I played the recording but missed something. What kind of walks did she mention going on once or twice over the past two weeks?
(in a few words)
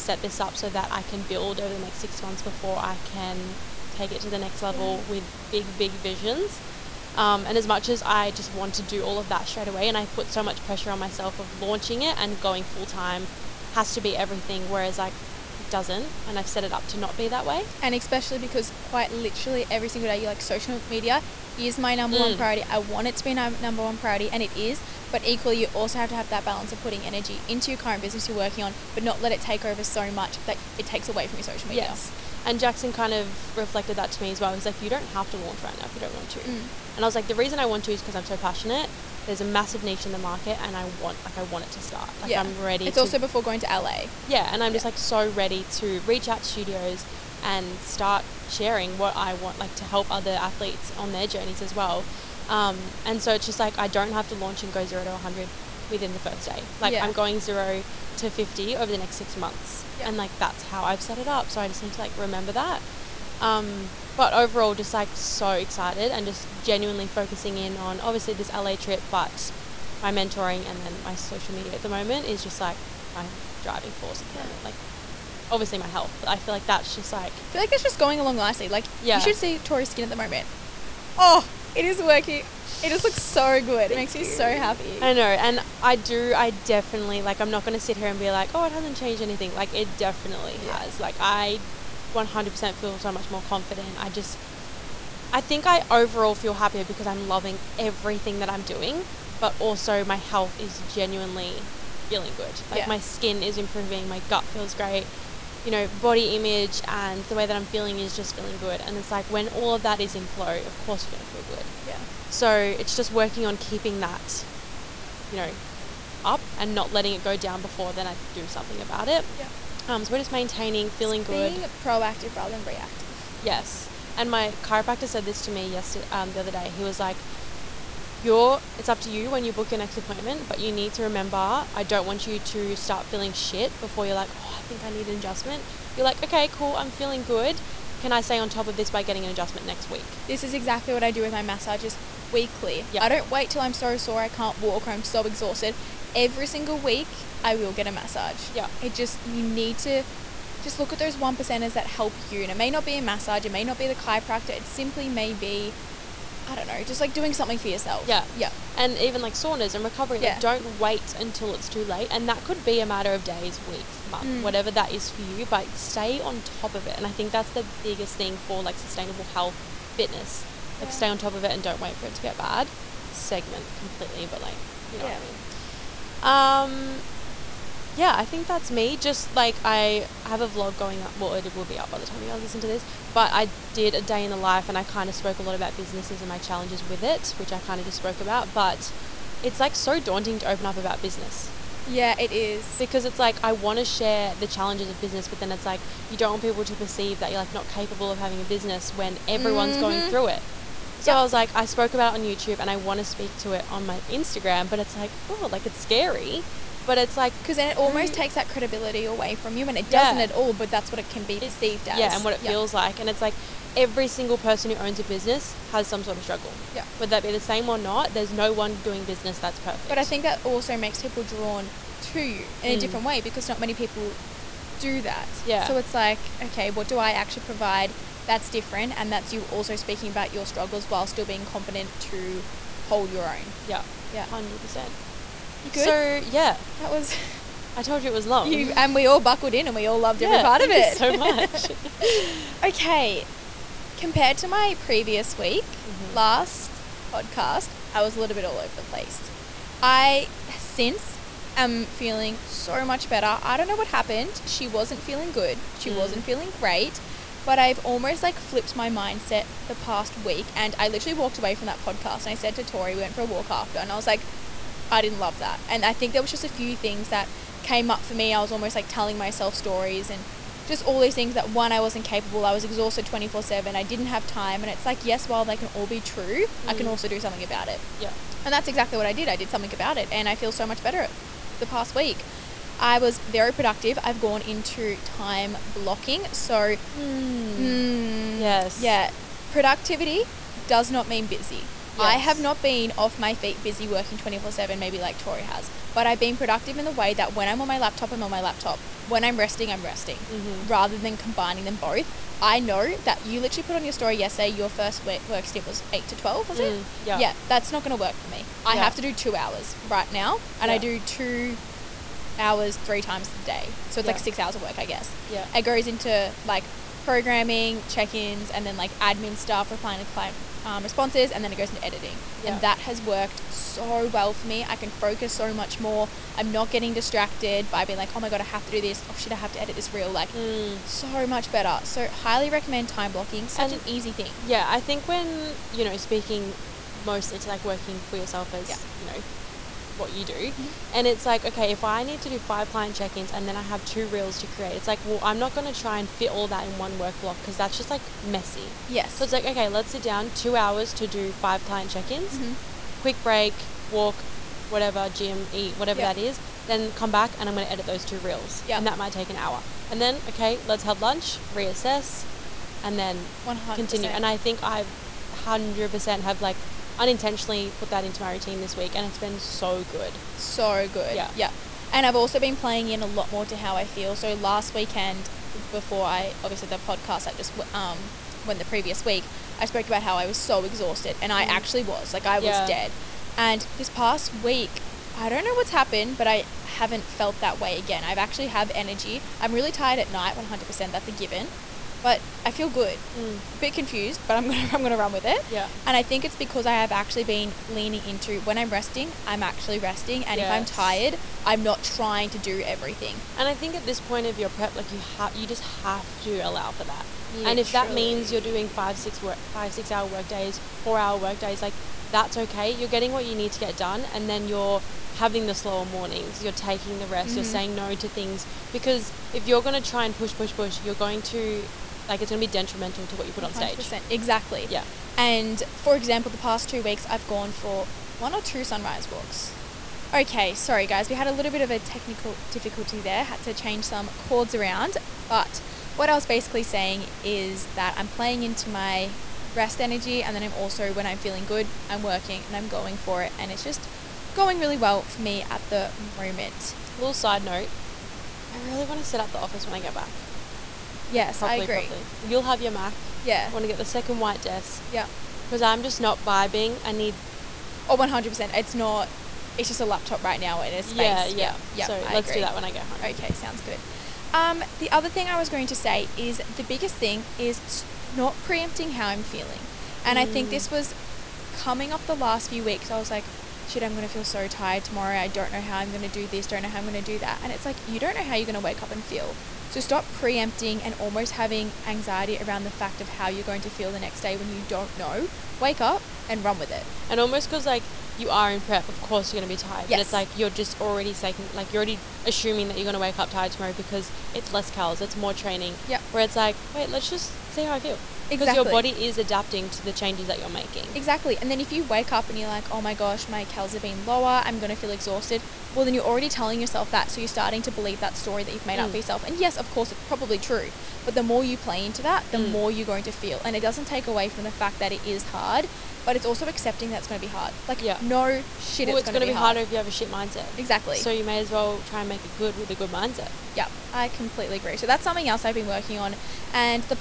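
sunrise walks.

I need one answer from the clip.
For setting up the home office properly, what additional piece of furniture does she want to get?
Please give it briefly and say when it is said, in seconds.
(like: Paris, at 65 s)
second white desk, at 453 s.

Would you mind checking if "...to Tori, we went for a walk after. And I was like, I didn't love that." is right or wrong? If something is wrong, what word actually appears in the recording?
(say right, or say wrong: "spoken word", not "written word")
right.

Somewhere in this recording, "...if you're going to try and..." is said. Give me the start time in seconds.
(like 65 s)
419 s.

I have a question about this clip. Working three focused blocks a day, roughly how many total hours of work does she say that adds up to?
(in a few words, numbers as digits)
6 hours.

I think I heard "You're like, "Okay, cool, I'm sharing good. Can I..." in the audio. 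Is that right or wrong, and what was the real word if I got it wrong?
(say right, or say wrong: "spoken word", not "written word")
wrong: "feeling", not "sharing".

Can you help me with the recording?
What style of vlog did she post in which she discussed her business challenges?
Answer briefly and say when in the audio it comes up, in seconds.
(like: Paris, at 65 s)
day in the life, at 184 s.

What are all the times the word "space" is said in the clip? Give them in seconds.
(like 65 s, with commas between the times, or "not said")
460 s.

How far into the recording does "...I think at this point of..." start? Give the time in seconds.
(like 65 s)
403 s.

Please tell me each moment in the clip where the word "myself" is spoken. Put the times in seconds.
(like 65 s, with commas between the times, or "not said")
10 s, 269 s.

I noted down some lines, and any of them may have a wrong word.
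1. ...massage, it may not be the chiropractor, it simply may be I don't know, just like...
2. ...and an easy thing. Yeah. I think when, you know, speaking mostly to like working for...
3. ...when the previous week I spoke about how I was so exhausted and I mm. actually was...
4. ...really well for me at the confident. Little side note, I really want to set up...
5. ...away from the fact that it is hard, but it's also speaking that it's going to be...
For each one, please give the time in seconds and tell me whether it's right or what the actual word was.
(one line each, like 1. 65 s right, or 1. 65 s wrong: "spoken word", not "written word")
1. 153 s right
2. 333 s right
3. 378 s right
4. 444 s wrong: "moment", not "confident"
5. 514 s wrong: "accepting", not "speaking".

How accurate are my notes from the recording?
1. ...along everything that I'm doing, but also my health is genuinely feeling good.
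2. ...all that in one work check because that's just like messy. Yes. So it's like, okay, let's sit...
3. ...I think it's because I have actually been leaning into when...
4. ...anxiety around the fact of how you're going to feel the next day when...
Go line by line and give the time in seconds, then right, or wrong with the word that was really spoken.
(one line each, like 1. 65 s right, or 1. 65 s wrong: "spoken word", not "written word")
1. 97 s wrong: "loving", not "along"
2. 346 s wrong: "block", not "check"
3. 395 s right
4. 481 s right.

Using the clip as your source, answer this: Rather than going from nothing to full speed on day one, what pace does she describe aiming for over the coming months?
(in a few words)
zero to 50.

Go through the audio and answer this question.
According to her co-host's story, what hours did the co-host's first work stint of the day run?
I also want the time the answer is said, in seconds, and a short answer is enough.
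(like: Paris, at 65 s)
8 to 12, at 305 s.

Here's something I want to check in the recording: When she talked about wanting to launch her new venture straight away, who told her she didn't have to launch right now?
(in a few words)
Jackson.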